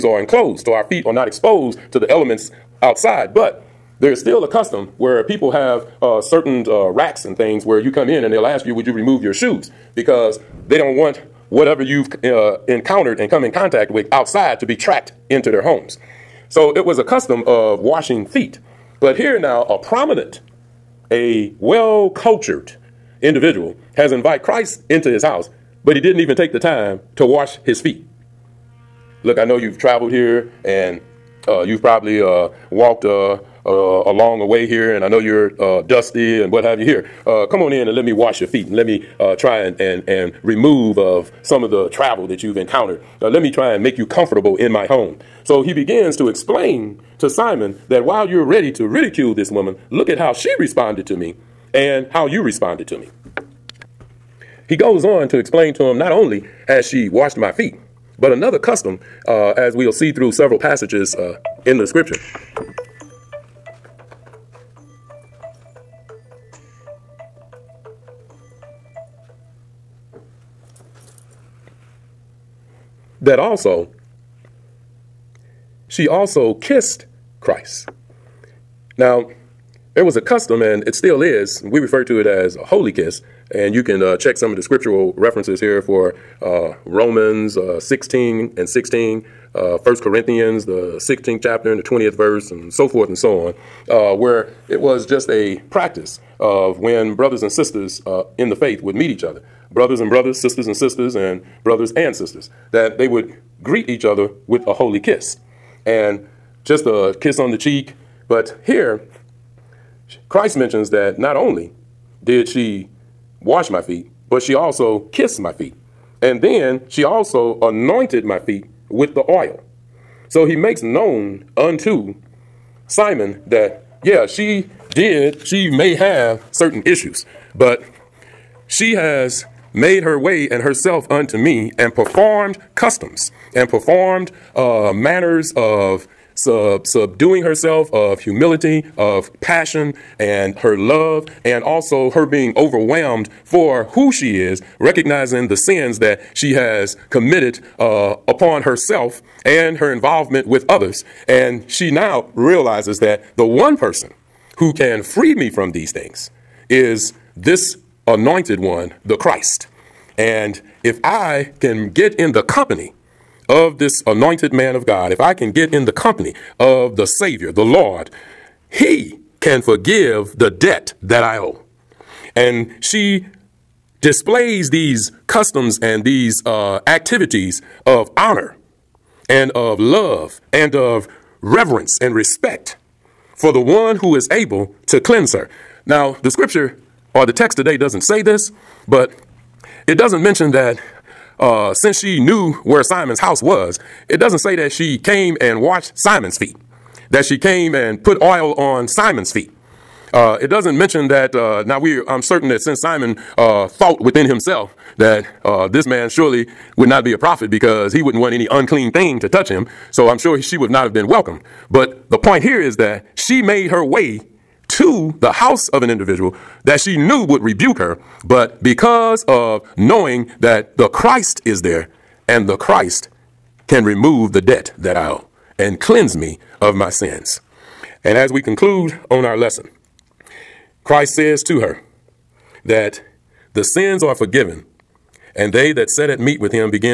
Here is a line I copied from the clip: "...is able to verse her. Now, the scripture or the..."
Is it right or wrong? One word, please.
wrong.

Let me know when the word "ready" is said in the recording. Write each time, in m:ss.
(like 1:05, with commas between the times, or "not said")
0:48.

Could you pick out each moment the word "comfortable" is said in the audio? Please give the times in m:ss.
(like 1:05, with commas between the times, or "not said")
0:44.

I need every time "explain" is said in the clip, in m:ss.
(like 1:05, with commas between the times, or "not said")
0:46, 0:55.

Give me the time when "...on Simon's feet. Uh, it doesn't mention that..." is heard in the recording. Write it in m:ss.
3:18.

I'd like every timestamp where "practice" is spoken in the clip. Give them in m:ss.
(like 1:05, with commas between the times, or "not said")
1:35.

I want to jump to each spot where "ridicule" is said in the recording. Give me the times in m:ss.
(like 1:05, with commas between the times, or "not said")
0:48.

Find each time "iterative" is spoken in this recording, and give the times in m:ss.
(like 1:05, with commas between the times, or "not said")
not said.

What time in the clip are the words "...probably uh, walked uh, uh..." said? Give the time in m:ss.
0:31.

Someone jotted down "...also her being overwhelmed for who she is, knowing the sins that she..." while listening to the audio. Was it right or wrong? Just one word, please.
wrong.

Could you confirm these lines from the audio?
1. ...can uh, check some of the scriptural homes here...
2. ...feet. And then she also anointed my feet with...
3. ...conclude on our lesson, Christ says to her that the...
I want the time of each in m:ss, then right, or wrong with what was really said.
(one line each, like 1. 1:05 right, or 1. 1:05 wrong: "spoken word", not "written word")
1. 1:23 wrong: "references", not "homes"
2. 1:55 right
3. 3:48 right.